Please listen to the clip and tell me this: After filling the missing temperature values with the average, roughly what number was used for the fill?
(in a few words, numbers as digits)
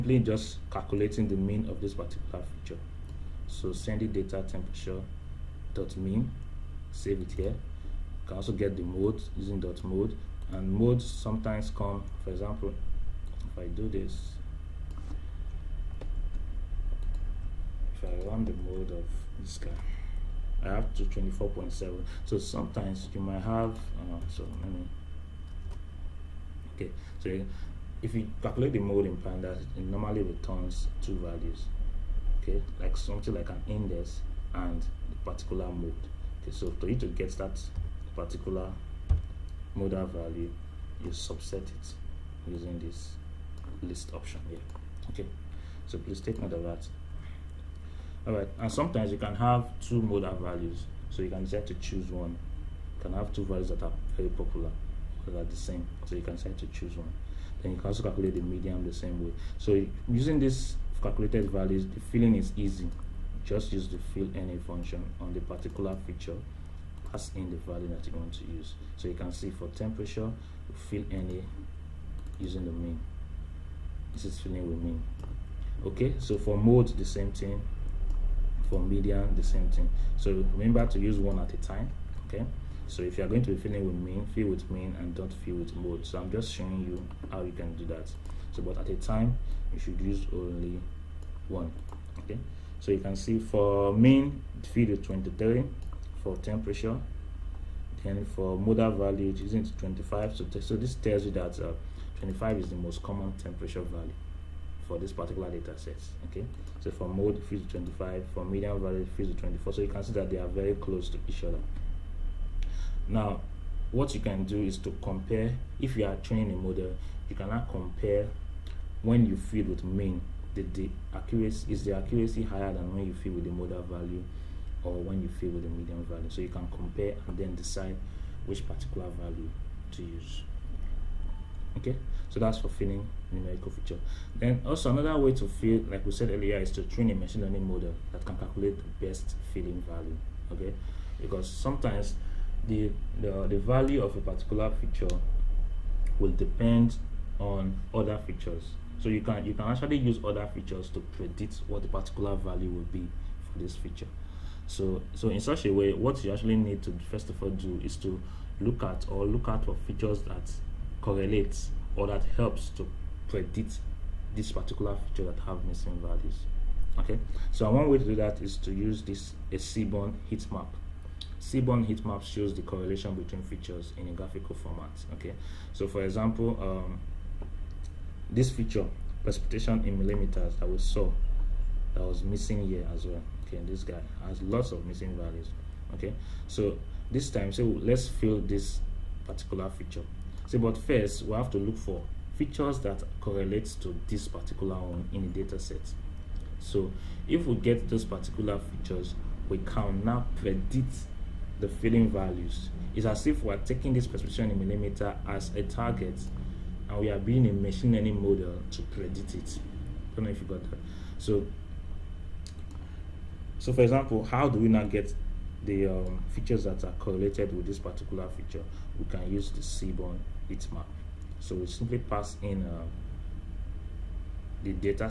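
23.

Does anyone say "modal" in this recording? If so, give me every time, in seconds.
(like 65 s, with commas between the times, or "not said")
39 s, 50 s, 98 s.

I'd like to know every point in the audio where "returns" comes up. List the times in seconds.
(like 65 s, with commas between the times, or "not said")
30 s.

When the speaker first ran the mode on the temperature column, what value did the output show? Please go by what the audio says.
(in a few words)
24.7.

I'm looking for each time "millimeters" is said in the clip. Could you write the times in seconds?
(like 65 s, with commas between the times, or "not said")
179 s, 204 s.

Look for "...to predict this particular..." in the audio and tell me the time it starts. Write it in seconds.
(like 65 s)
162 s.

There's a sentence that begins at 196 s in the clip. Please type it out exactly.
So if we get those particular features, we can now predict the filling values.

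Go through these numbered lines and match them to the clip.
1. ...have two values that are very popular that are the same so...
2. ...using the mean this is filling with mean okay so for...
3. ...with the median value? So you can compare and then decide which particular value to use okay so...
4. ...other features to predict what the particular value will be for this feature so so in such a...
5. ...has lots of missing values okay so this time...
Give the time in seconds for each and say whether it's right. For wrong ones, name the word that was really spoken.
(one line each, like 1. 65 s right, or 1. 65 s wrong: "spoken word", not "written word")
1. 53 s right
2. 72 s right
3. 125 s right
4. 150 s right
5. 184 s right.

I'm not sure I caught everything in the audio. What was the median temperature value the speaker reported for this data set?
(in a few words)
24.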